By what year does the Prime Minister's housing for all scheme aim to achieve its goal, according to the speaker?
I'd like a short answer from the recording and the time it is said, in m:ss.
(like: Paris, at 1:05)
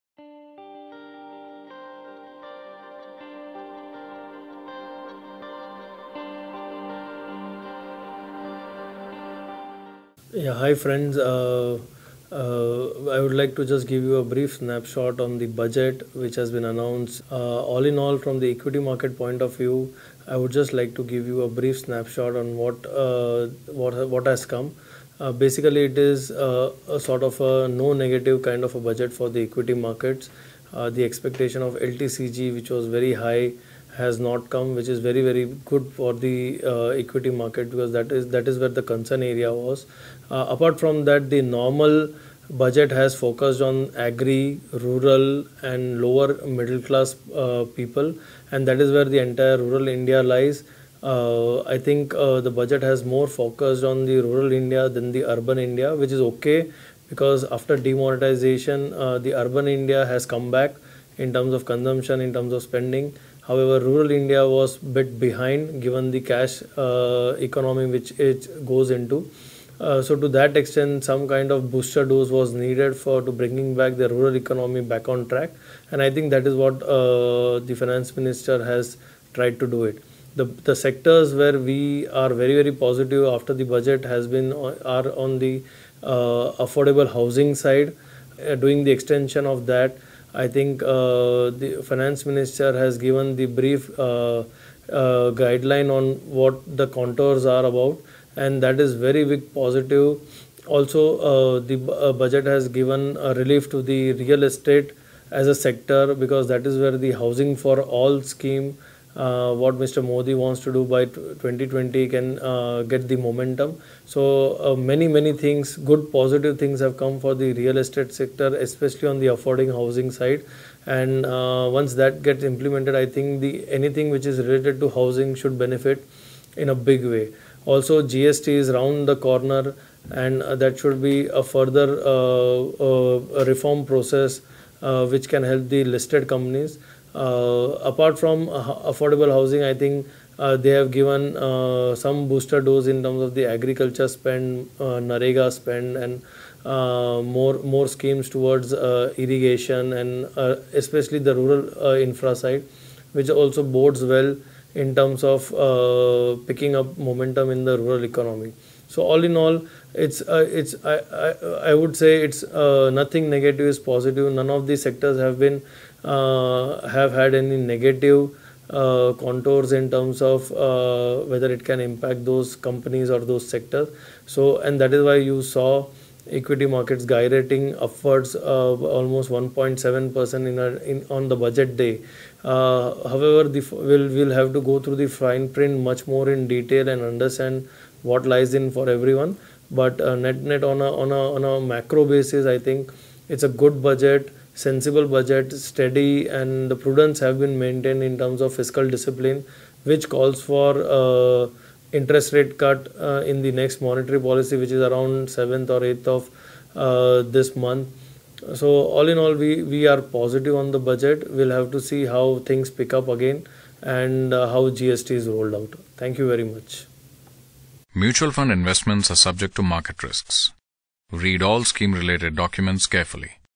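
2020, at 1:51.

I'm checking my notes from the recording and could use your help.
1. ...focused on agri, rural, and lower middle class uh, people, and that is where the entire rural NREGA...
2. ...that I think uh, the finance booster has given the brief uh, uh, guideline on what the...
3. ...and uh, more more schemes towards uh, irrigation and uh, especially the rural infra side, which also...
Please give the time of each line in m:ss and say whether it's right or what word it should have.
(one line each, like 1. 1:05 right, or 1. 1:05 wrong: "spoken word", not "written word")
1. 0:43 wrong: "India", not "NREGA"
2. 1:29 wrong: "minister", not "booster"
3. 2:25 right.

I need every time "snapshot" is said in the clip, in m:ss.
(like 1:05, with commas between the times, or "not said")
0:14, 0:21.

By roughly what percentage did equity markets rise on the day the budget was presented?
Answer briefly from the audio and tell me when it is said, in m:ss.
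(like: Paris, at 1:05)
1.7 percent, at 2:59.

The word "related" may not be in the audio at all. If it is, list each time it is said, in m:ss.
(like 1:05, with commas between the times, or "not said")
2:04, 3:41.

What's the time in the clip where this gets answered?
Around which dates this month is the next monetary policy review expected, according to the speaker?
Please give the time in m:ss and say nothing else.
3:25.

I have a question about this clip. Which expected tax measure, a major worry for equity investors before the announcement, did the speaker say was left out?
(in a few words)
LTCG.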